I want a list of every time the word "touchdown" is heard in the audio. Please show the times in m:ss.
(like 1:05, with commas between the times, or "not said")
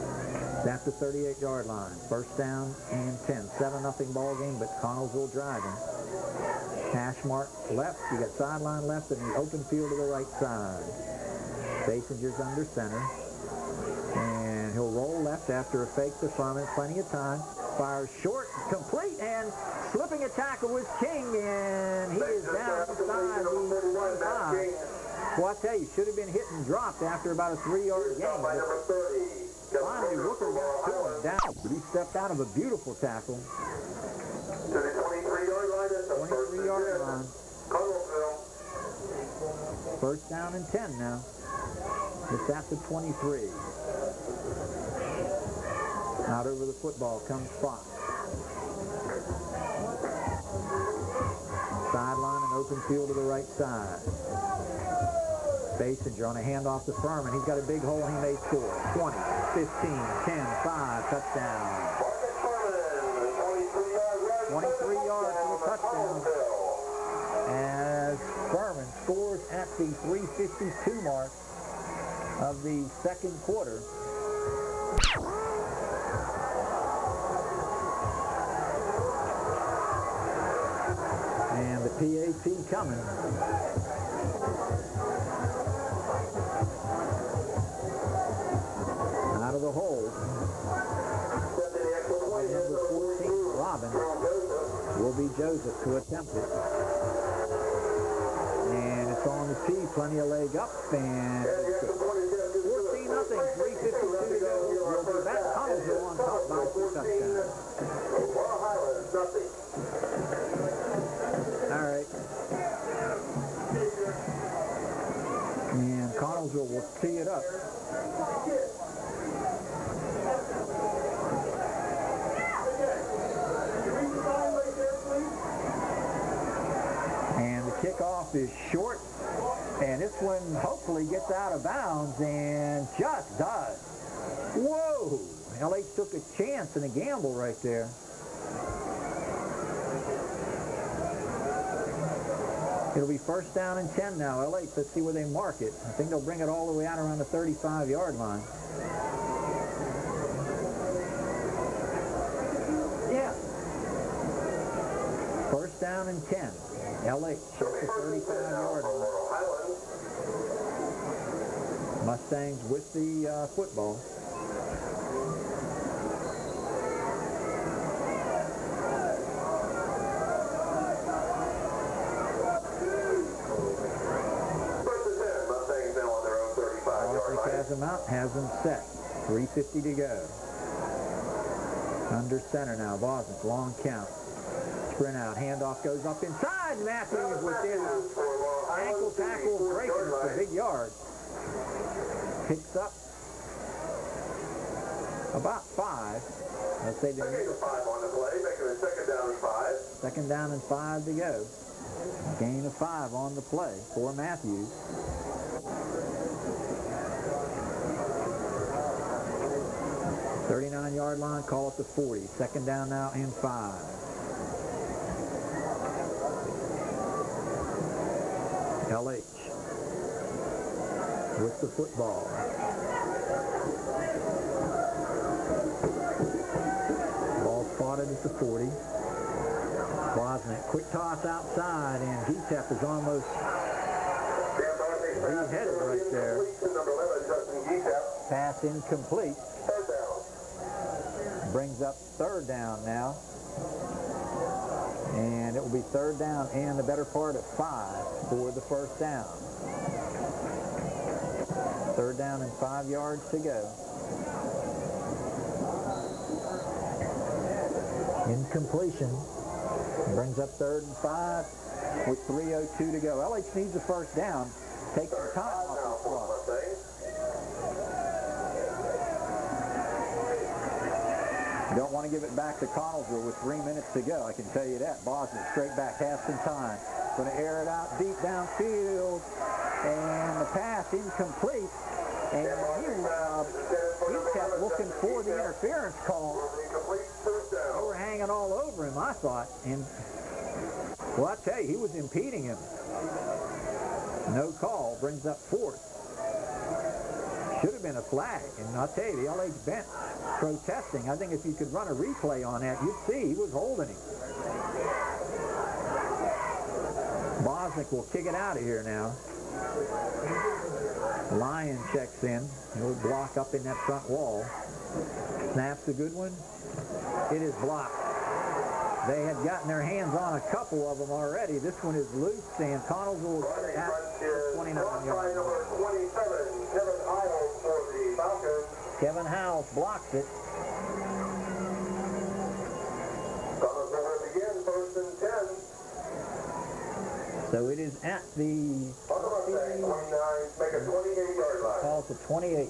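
1:01, 1:05, 1:46.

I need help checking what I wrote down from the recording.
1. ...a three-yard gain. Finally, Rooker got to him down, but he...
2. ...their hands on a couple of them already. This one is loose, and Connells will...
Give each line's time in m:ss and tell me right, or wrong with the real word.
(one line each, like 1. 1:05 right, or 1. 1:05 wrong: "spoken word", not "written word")
1. 0:27 right
2. 5:19 right.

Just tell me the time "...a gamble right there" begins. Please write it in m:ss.
2:16.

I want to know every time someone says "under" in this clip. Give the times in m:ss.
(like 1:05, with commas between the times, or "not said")
0:12, 3:02.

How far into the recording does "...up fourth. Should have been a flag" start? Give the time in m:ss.
4:55.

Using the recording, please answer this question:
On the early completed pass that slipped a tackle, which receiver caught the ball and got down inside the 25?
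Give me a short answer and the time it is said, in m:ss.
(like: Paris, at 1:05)
King, at 0:21.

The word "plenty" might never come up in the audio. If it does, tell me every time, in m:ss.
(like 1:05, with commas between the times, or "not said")
0:16, 1:39.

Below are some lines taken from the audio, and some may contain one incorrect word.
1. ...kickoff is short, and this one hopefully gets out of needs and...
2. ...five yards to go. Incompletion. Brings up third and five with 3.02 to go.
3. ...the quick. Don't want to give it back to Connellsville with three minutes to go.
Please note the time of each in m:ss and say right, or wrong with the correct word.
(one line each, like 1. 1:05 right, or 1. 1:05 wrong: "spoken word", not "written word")
1. 2:07 wrong: "bounds", not "needs"
2. 4:12 right
3. 4:26 wrong: "clock", not "quick".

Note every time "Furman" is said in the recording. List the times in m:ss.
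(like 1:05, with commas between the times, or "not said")
0:16, 0:57, 1:08.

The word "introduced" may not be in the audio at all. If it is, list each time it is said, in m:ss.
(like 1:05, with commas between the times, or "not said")
not said.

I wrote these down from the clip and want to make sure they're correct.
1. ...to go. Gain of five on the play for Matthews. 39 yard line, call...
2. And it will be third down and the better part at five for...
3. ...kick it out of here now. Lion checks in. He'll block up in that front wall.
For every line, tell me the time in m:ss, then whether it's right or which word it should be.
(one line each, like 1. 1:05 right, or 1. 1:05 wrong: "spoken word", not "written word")
1. 3:21 right
2. 4:05 right
3. 5:08 right.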